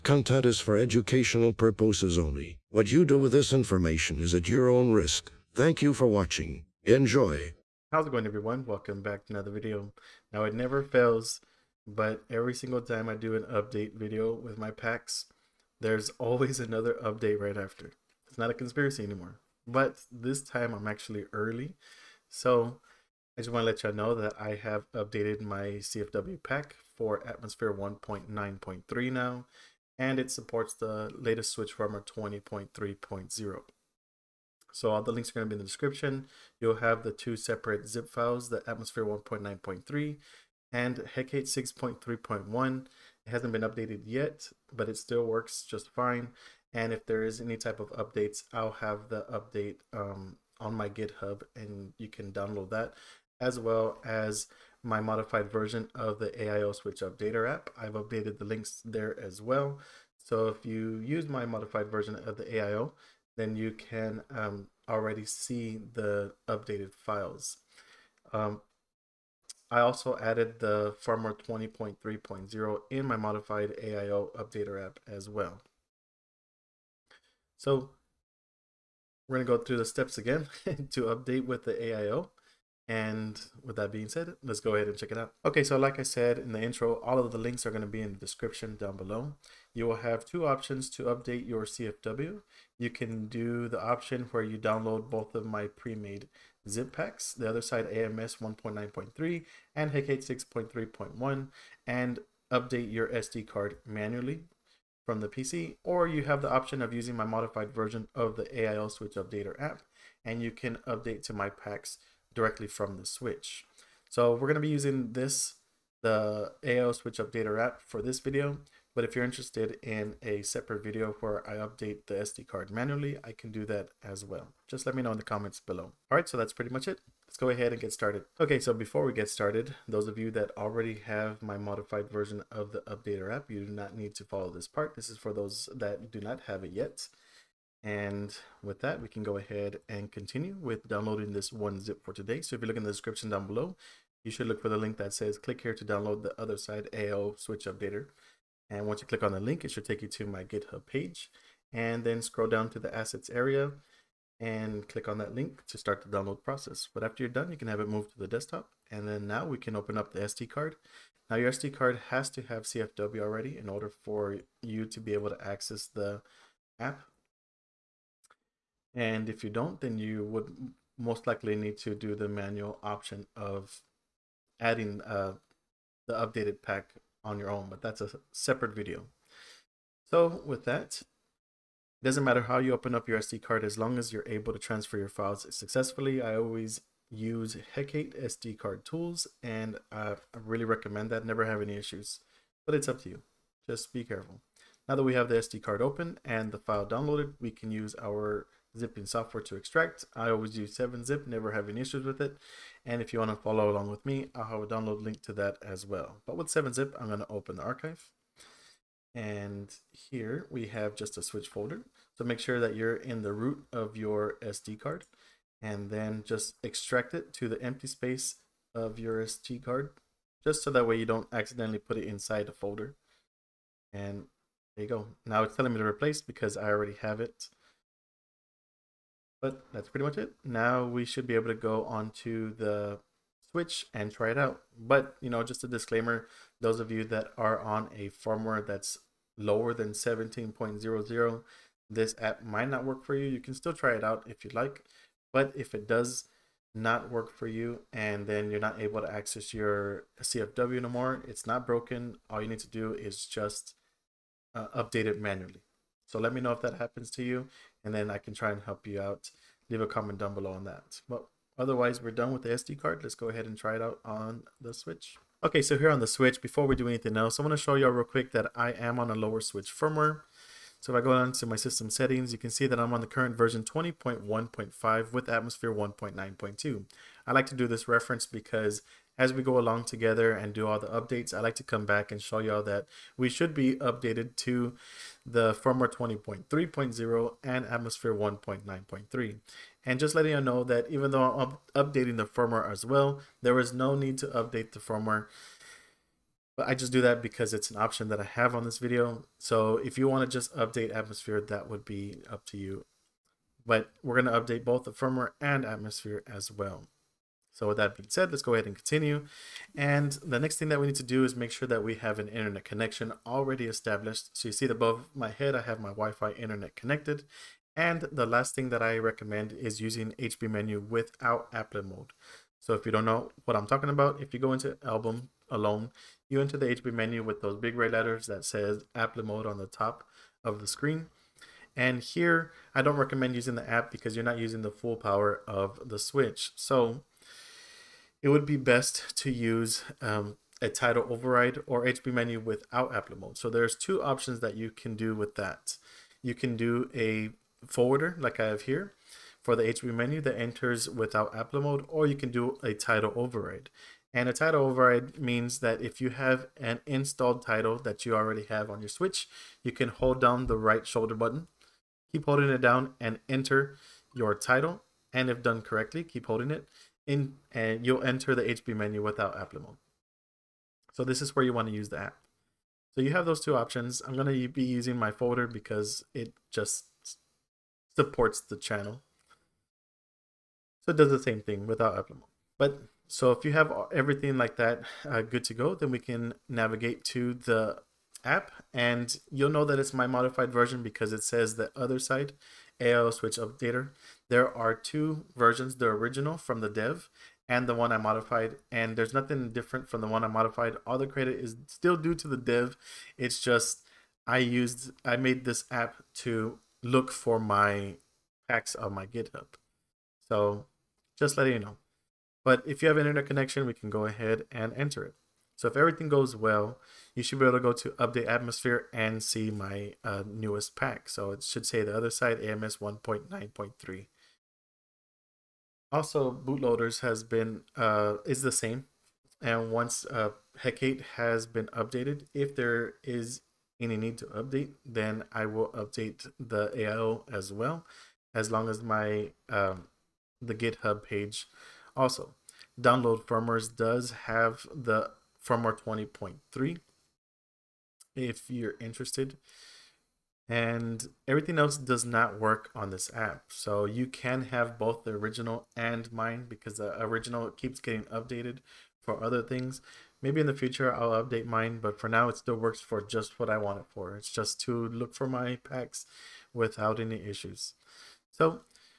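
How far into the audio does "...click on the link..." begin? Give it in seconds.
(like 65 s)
149 s.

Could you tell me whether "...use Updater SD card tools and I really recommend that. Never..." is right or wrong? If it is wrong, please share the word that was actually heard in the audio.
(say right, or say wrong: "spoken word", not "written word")
wrong: "Hekate", not "Updater".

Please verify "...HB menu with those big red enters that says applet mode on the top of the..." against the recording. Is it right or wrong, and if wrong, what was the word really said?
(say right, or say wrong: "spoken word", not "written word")
wrong: "letters", not "enters".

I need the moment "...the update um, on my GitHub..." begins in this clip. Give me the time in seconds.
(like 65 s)
49 s.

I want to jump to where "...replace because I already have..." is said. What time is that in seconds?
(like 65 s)
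225 s.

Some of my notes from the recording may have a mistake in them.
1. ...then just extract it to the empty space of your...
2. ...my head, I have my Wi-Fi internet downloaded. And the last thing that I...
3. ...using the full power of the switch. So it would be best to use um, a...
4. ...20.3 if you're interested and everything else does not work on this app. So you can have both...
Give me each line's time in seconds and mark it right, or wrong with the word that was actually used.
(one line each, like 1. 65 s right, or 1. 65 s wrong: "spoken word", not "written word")
1. 215 s right
2. 315 s wrong: "connected", not "downloaded"
3. 334 s right
4. 445 s right.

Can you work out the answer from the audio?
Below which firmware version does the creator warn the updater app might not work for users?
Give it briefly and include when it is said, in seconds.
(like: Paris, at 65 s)
17.00, at 239 s.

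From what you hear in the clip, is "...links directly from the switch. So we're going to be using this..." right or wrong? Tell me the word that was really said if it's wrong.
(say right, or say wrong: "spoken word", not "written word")
wrong: "packs", not "links".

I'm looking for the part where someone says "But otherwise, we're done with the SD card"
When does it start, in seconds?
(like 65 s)
261 s.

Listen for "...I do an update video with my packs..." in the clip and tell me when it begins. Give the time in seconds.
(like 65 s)
13 s.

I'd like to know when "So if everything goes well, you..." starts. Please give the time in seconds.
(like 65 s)
415 s.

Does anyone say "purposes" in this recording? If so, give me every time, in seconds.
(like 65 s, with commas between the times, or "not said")
1 s.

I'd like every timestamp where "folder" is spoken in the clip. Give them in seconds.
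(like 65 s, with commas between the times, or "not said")
211 s, 222 s, 375 s.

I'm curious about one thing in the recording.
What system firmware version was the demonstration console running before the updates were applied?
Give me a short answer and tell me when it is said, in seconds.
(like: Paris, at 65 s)
20.1.5, at 273 s.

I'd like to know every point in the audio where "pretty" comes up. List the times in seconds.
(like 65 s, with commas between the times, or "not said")
126 s, 229 s.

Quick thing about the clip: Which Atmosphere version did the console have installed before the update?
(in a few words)
1.9.2.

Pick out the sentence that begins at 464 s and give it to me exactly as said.
It's just to look for my packs without any issues.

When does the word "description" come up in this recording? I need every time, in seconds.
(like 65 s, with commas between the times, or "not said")
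35 s, 88 s, 142 s.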